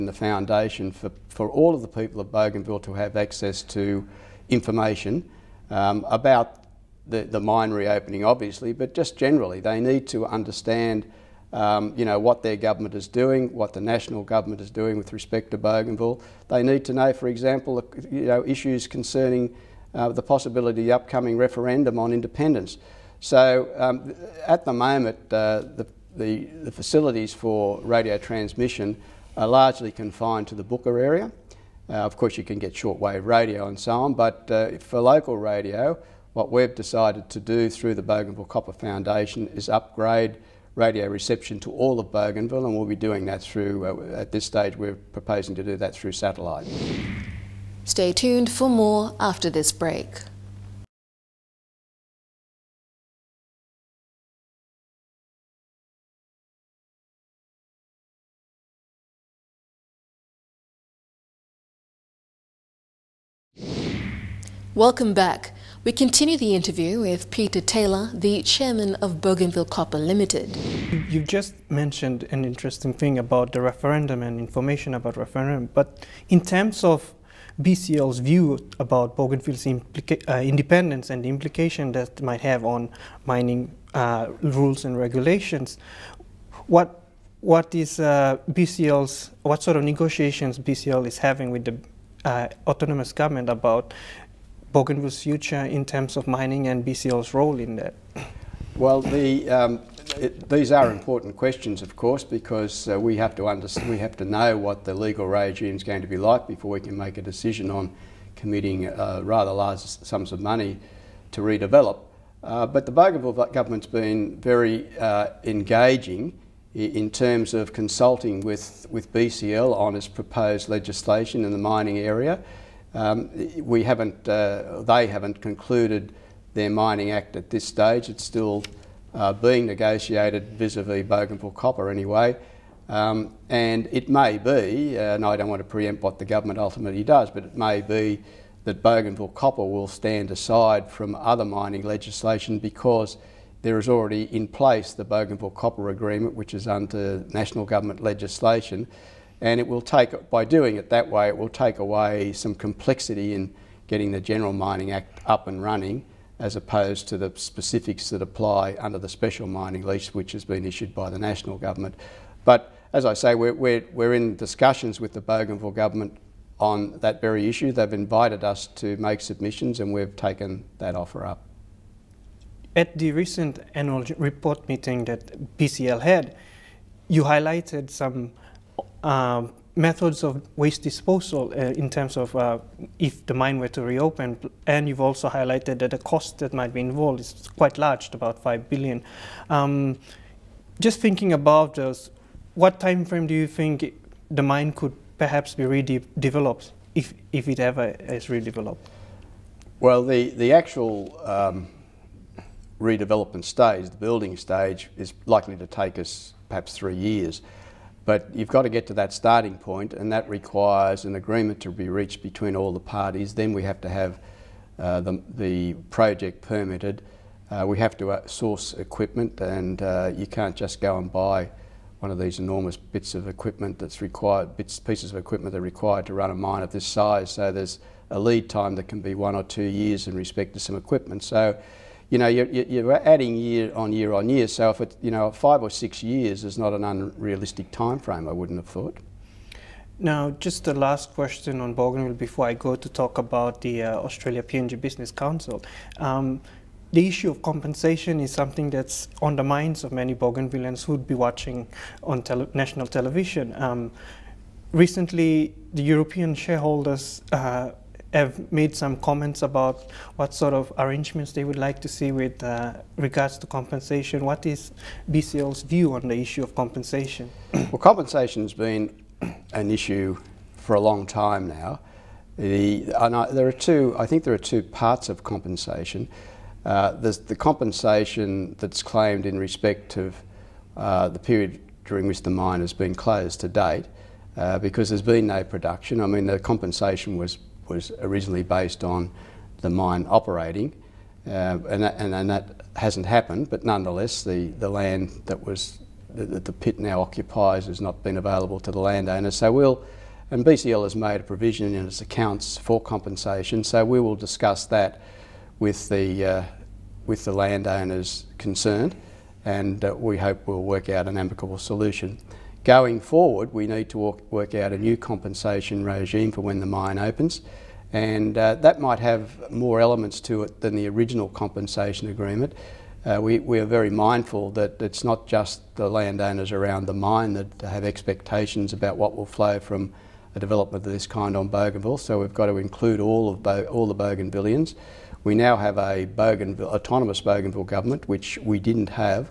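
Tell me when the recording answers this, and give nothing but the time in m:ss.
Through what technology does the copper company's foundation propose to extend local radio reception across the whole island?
0:46.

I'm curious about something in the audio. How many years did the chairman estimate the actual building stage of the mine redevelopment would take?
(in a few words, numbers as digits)
3 years.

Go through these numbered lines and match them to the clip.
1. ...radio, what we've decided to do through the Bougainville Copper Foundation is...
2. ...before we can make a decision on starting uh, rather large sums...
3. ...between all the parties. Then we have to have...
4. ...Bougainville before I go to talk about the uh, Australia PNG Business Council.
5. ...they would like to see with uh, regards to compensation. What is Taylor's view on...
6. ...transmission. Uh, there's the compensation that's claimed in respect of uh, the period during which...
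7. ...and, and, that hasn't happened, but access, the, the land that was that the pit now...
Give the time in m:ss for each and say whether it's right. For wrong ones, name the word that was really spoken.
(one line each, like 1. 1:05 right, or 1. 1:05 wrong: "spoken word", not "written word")
1. 0:35 right
2. 1:46 wrong: "committing", not "starting"
3. 3:32 right
4. 4:01 right
5. 4:21 wrong: "BCL", not "Taylor"
6. 4:35 wrong: "compensation", not "transmission"
7. 4:51 wrong: "nonetheless", not "access".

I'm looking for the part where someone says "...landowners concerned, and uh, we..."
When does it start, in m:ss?
5:07.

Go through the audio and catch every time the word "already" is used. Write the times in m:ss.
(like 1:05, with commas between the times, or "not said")
2:23.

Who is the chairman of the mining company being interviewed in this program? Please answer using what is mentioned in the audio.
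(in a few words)
Peter Taylor.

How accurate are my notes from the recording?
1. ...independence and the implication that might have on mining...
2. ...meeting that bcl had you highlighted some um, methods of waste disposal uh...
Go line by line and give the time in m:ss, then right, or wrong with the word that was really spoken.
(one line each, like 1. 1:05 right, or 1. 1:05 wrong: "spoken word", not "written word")
1. 1:20 right
2. 2:54 right.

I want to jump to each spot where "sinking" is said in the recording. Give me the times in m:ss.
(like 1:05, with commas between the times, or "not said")
not said.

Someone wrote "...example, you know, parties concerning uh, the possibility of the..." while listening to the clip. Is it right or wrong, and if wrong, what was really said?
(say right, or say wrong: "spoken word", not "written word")
wrong: "issues", not "parties".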